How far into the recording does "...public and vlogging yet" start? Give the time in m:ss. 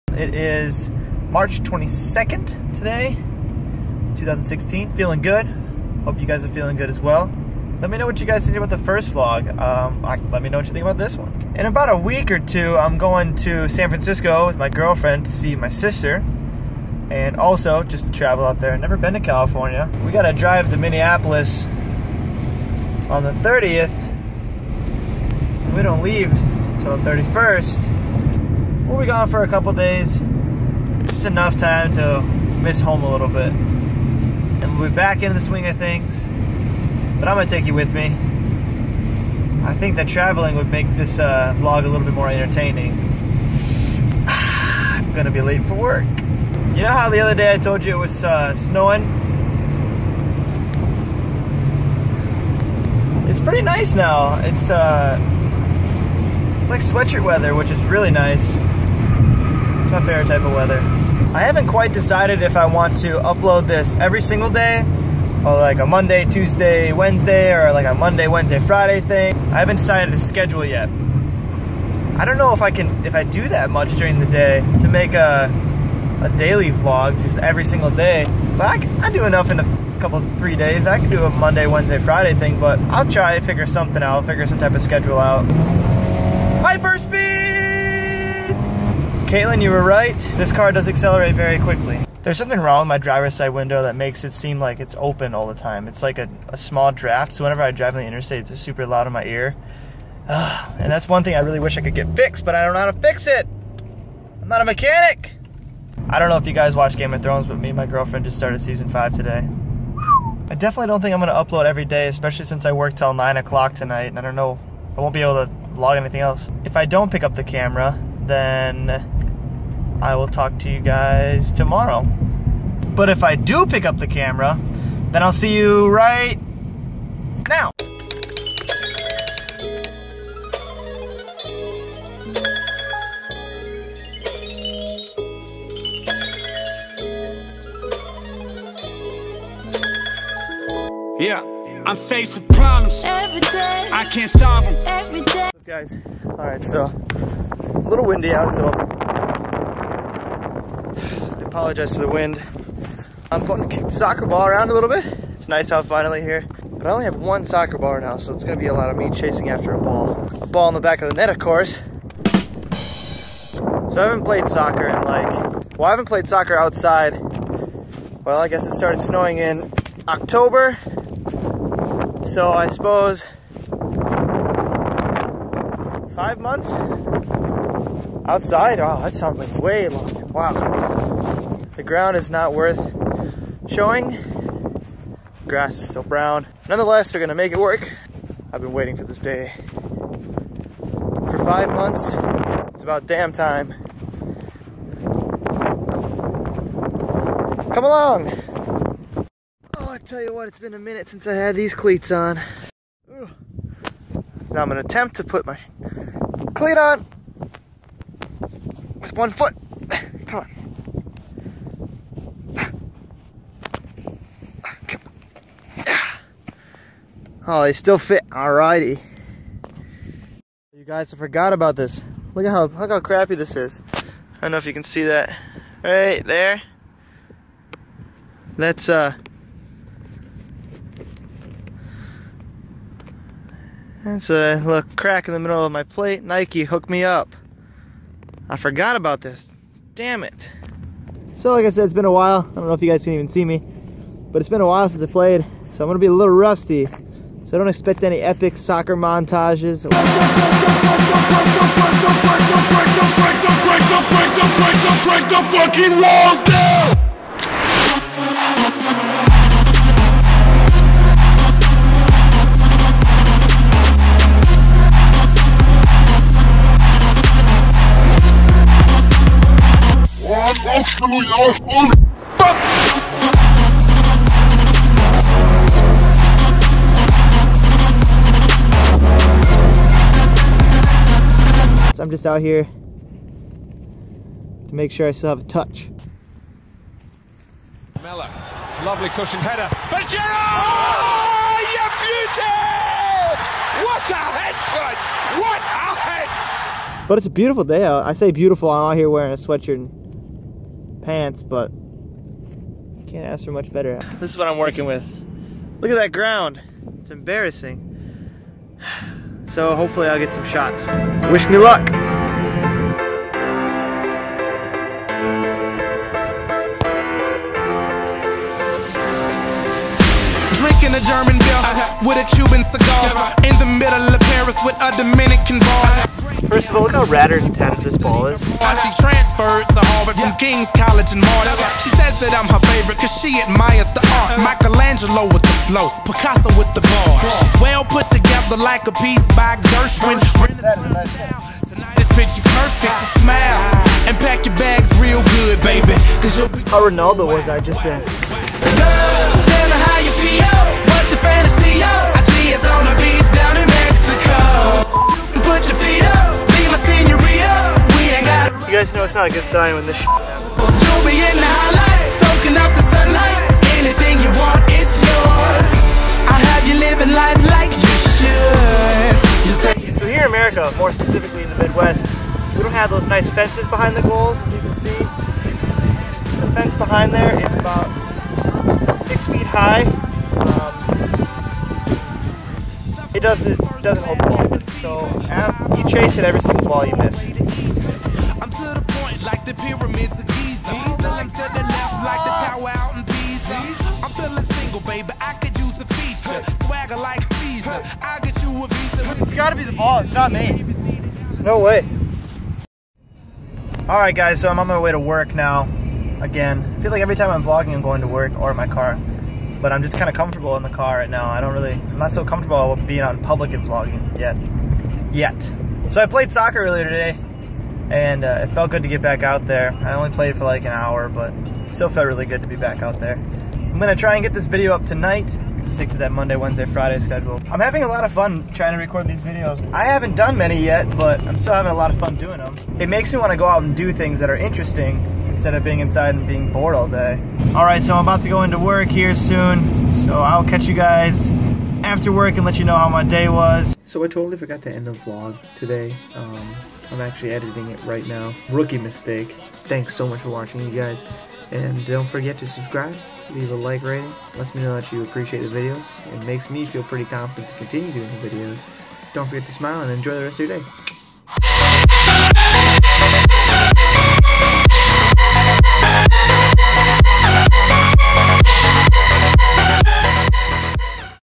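6:53.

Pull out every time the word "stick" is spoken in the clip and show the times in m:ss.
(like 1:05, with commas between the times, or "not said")
7:05.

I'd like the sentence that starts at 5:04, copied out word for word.
This is what I'm working with.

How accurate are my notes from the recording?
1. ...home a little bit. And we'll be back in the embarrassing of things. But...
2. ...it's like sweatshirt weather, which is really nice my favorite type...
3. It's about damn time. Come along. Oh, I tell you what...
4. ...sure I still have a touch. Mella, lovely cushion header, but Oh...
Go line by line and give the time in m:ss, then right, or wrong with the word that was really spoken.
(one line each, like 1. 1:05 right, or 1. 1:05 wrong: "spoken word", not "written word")
1. 0:32 wrong: "swing", not "embarrassing"
2. 0:56 right
3. 3:12 right
4. 4:44 right.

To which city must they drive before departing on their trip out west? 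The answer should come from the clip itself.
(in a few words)
Minneapolis.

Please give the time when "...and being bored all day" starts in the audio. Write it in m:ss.
7:16.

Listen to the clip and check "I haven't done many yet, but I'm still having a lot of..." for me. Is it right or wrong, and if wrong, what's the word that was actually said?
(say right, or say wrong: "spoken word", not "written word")
right.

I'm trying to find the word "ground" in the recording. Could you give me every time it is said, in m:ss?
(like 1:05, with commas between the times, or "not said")
3:01, 5:06.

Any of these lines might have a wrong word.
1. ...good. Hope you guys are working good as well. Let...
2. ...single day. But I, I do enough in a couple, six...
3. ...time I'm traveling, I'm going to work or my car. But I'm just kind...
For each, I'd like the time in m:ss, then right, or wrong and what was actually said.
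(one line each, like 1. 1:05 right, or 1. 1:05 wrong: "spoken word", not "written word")
1. 0:05 wrong: "feeling", not "working"
2. 1:17 wrong: "three", not "six"
3. 6:47 wrong: "vlogging", not "traveling".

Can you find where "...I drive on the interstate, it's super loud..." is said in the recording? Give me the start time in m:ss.
1:37.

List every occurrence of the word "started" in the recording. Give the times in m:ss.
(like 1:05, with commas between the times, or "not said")
1:48, 2:48.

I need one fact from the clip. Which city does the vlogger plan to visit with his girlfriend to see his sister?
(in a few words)
San Francisco.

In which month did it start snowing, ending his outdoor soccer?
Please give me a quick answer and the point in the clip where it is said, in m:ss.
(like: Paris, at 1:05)
October, at 2:50.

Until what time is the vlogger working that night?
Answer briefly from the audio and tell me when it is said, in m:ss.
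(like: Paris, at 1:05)
9, at 1:53.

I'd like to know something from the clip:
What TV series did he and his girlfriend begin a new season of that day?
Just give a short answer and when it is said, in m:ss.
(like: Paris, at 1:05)
Game of Thrones, at 1:46.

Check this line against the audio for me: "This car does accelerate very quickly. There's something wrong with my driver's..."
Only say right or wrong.
right.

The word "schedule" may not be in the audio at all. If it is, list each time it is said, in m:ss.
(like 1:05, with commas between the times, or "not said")
1:10, 1:24, 7:07.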